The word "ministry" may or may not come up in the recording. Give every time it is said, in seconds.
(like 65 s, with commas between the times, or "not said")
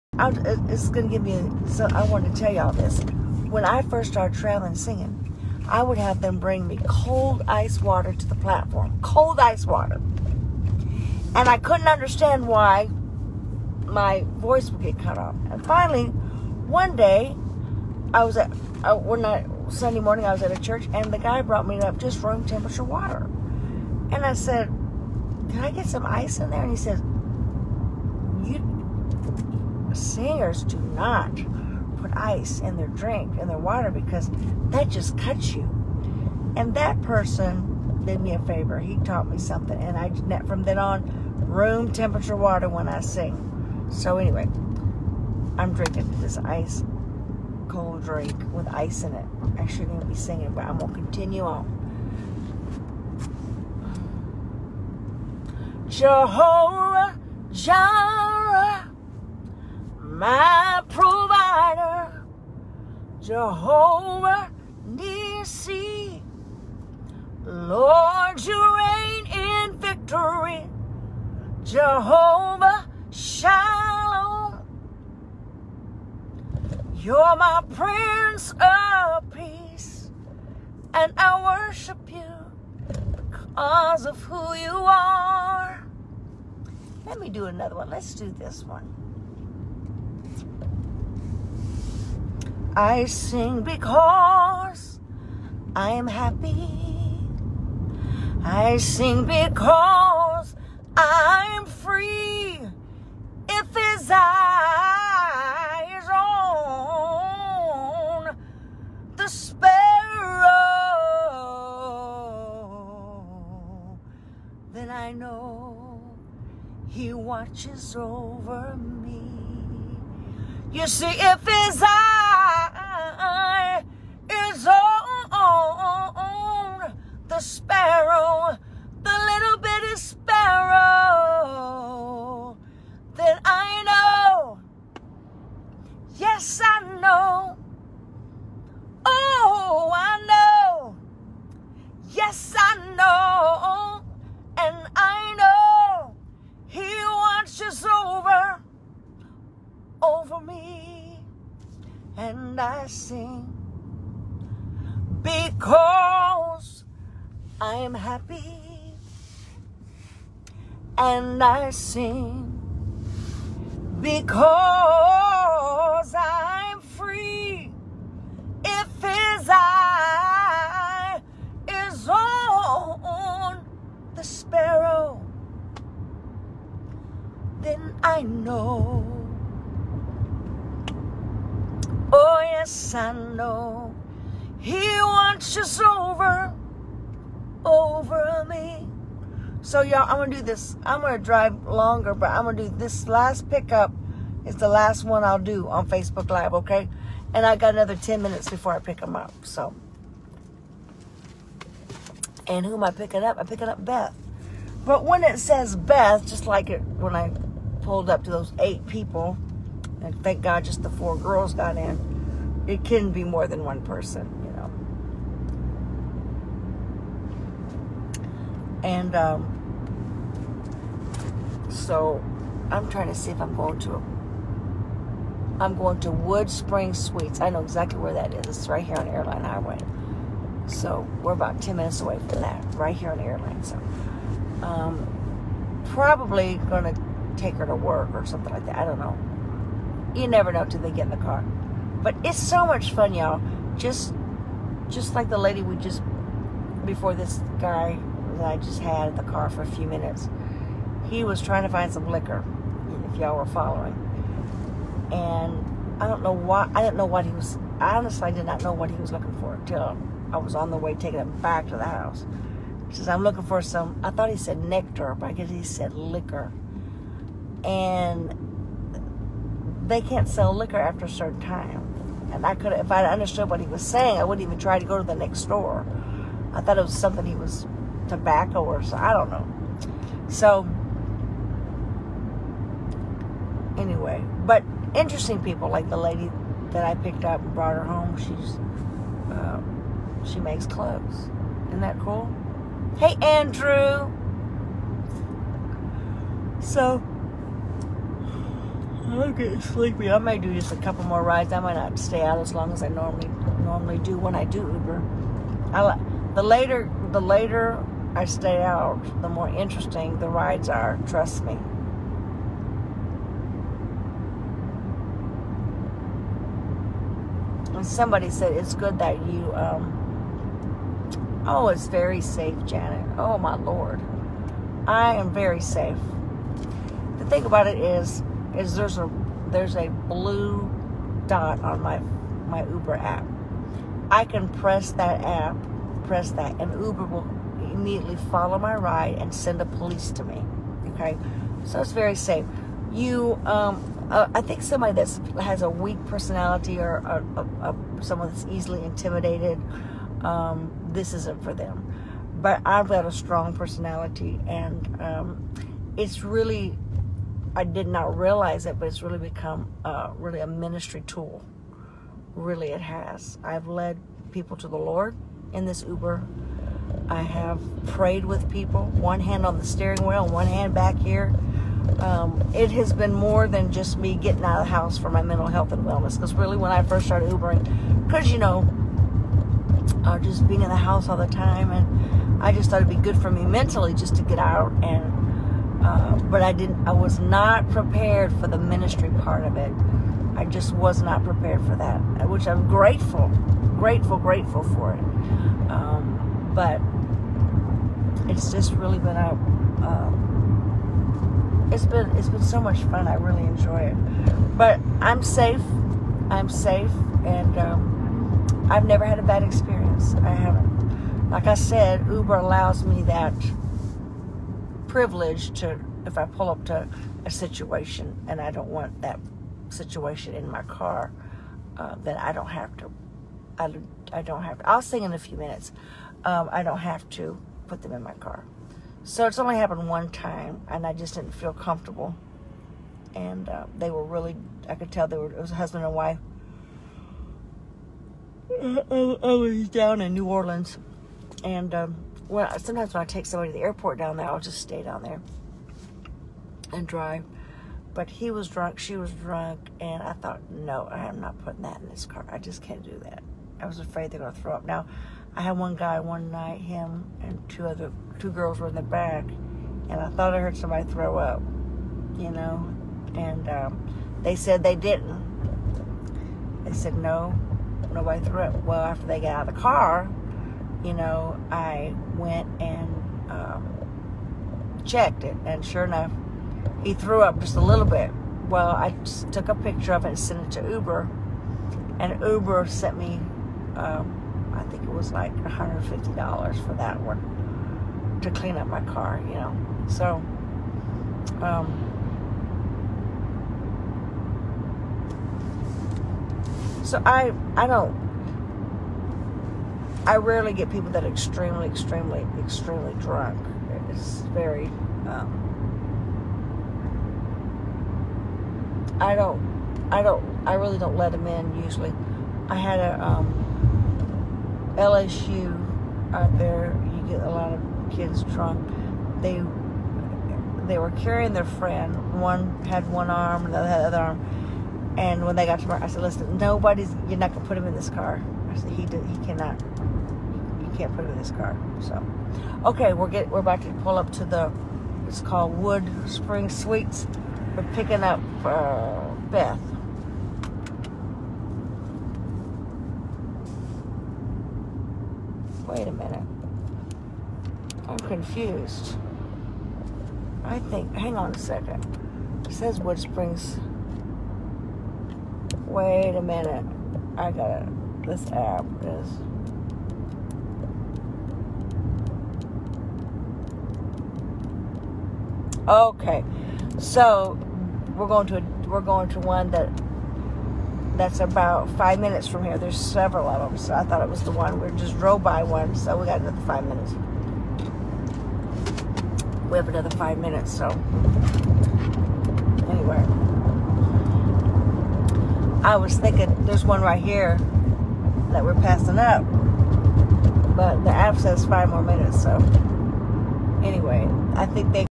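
360 s, 388 s.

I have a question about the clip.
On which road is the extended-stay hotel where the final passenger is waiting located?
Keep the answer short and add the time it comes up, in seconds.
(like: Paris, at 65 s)
Airline Highway, at 229 s.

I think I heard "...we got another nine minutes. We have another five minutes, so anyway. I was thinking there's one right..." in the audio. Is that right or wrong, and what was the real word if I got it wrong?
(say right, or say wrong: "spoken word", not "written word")
wrong: "five", not "nine".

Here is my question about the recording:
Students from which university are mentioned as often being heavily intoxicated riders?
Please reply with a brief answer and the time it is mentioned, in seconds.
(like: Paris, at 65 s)
LSU, at 514 s.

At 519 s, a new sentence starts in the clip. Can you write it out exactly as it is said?
They they were carrying their friend.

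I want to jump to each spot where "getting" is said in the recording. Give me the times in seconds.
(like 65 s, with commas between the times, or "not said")
299 s, 374 s.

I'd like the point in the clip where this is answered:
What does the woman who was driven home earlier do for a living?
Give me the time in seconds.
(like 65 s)
290 s.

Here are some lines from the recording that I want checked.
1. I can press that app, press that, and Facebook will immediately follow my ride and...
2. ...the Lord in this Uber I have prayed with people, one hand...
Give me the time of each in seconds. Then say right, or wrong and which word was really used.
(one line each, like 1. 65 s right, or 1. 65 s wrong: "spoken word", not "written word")
1. 334 s wrong: "Uber", not "Facebook"
2. 364 s right.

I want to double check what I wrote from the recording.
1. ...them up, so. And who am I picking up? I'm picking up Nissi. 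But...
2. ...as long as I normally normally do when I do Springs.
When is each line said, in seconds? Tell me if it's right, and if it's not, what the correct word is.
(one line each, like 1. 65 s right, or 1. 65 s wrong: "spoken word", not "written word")
1. 198 s wrong: "Beth", not "Nissi"
2. 302 s wrong: "Uber", not "Springs".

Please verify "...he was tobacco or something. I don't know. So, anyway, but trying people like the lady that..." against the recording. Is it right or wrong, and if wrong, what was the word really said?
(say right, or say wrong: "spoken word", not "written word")
wrong: "interesting", not "trying".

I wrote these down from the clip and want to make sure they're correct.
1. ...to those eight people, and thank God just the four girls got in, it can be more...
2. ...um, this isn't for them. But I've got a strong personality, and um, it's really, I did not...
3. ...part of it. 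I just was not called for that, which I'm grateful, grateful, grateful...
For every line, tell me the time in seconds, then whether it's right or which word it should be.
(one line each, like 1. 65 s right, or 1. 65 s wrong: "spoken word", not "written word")
1. 208 s right
2. 350 s right
3. 389 s wrong: "prepared", not "called".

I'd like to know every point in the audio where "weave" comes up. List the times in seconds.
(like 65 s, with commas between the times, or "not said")
not said.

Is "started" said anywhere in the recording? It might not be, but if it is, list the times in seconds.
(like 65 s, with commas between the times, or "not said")
4 s, 377 s.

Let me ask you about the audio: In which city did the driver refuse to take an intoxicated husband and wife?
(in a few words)
New Orleans.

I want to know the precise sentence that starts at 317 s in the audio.
And somebody said, it's good that you, um, oh, it's very safe, Janet.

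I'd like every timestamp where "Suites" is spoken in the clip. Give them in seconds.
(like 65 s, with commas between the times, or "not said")
226 s, 536 s.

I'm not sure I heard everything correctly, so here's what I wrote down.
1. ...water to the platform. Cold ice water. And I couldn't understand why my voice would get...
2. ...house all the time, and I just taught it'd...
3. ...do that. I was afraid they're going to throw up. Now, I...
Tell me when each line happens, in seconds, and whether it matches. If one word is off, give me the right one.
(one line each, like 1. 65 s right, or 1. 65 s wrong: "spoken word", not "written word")
1. 7 s right
2. 380 s wrong: "thought", not "taught"
3. 452 s right.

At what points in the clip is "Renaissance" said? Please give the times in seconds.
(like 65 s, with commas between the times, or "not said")
not said.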